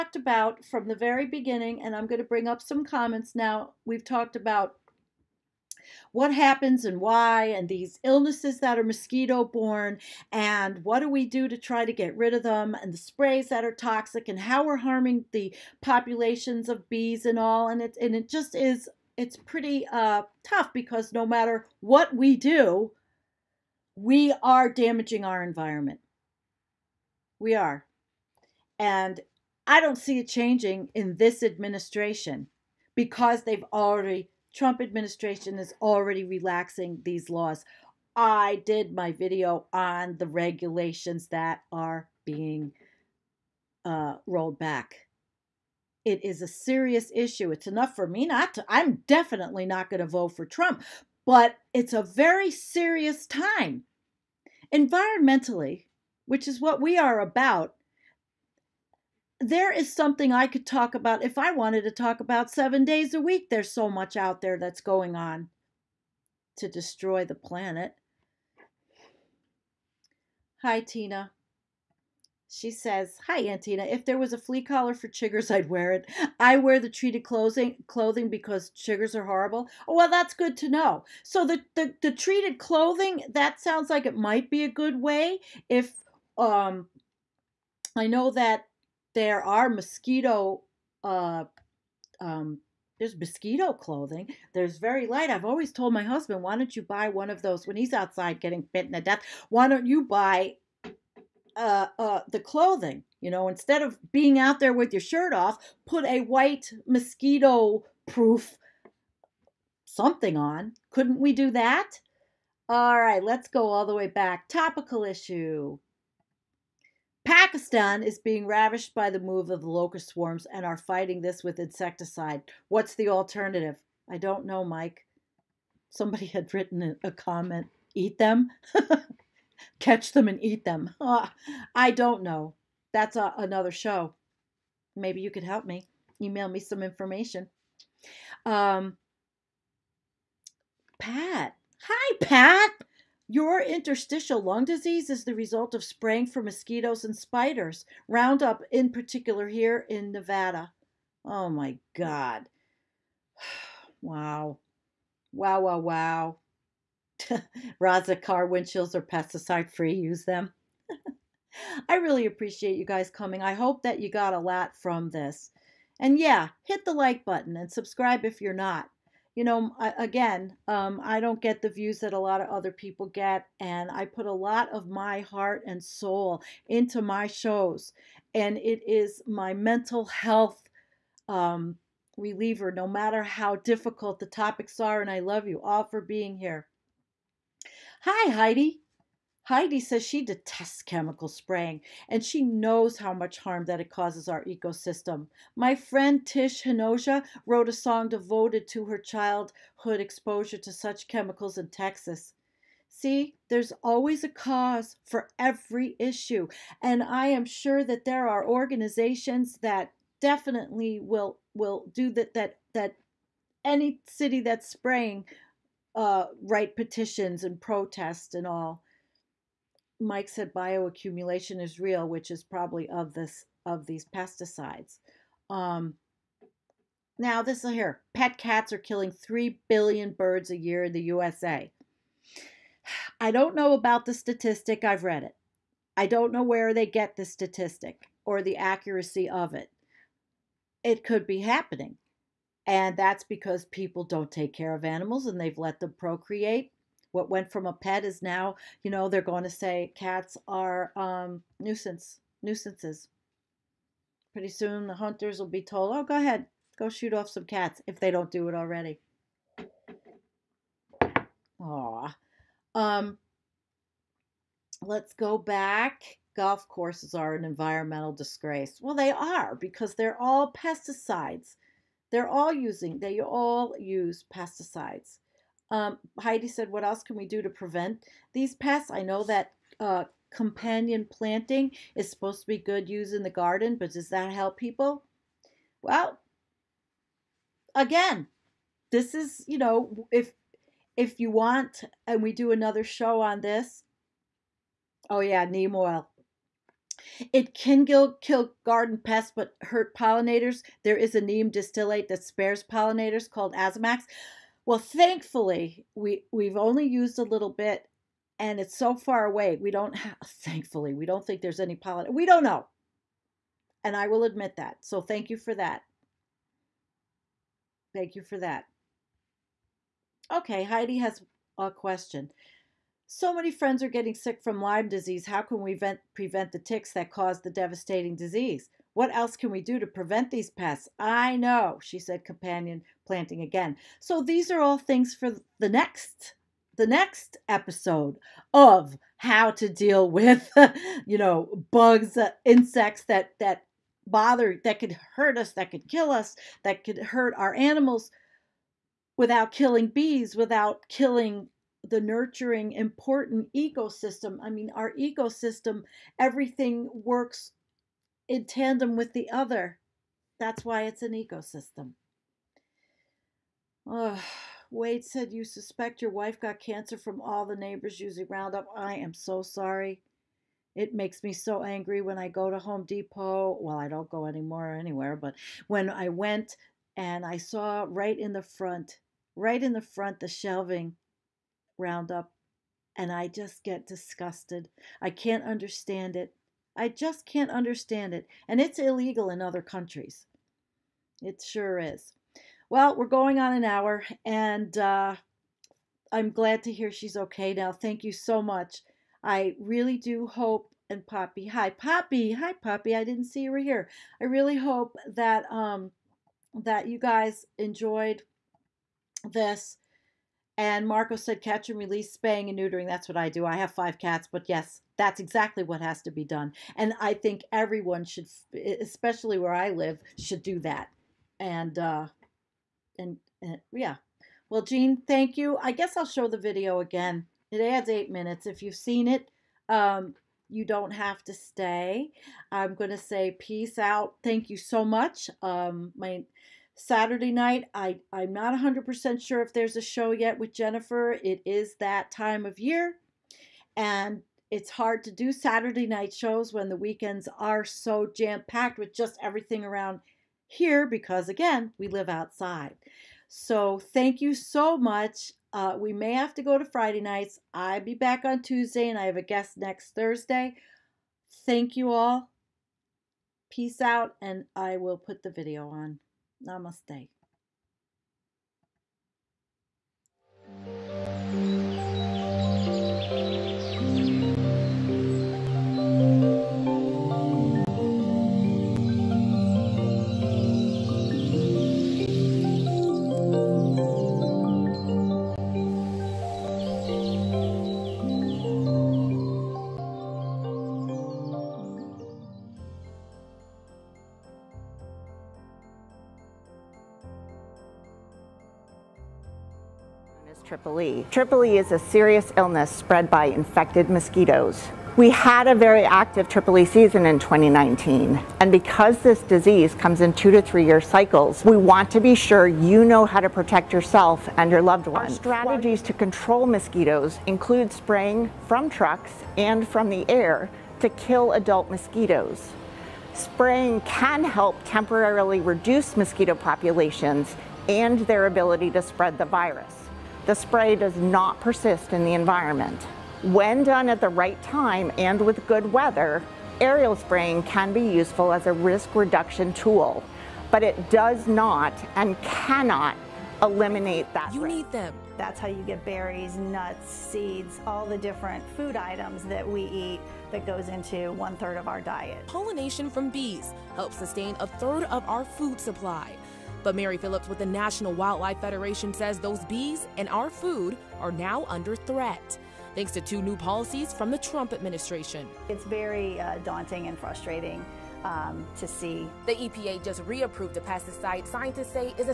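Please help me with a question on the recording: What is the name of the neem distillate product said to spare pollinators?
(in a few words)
AzaMax.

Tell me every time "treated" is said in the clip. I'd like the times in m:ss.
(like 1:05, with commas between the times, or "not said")
1:16, 1:22.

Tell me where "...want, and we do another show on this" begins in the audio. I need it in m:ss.
4:51.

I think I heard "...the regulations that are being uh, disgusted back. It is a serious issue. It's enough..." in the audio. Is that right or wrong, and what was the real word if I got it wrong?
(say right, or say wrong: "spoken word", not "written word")
wrong: "rolled", not "disgusted".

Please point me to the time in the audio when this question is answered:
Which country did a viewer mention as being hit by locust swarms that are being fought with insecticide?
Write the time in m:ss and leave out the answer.
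1:57.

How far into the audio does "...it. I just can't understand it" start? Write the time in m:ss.
6:26.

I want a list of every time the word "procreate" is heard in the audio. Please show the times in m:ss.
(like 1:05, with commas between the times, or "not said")
4:05.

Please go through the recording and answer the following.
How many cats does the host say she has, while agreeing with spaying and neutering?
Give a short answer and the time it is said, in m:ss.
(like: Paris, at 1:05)
5, at 6:53.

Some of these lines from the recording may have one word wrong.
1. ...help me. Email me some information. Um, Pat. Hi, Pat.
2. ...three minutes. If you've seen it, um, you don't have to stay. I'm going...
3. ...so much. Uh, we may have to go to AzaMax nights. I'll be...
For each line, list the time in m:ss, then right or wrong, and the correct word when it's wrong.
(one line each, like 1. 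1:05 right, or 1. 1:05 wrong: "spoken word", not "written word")
1. 2:15 right
2. 7:07 wrong: "eight", not "three"
3. 7:34 wrong: "Friday", not "AzaMax".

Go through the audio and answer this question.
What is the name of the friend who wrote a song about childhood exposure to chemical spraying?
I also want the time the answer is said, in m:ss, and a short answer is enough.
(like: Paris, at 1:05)
Tish Hinojosa, at 3:16.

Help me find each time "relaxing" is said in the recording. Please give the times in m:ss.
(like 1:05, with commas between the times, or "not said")
0:36.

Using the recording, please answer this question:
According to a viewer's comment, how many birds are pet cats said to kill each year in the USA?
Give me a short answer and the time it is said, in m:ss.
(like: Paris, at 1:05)
3 billion, at 3:49.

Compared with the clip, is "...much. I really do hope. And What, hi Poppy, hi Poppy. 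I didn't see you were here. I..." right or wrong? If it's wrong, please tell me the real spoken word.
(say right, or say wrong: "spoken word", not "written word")
wrong: "Poppy", not "What".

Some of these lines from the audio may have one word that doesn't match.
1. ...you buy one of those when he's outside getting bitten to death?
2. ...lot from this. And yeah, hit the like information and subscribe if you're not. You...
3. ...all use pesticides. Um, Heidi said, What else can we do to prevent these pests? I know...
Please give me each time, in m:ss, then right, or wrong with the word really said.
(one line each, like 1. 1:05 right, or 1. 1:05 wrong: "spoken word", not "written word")
1. 1:36 right
2. 2:44 wrong: "button", not "information"
3. 4:33 right.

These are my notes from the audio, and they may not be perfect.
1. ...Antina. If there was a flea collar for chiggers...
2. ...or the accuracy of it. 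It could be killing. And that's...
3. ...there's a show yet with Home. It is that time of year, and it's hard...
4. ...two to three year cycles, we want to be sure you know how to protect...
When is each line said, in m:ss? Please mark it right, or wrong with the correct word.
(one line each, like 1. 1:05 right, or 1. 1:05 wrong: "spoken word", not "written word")
1. 1:13 right
2. 3:58 wrong: "happening", not "killing"
3. 7:19 wrong: "Jennifer", not "Home"
4. 8:30 right.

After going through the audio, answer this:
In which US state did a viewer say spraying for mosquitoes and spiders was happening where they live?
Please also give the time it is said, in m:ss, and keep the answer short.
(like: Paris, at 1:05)
Nevada, at 2:30.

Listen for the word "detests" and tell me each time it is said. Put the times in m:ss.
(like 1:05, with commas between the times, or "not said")
3:10.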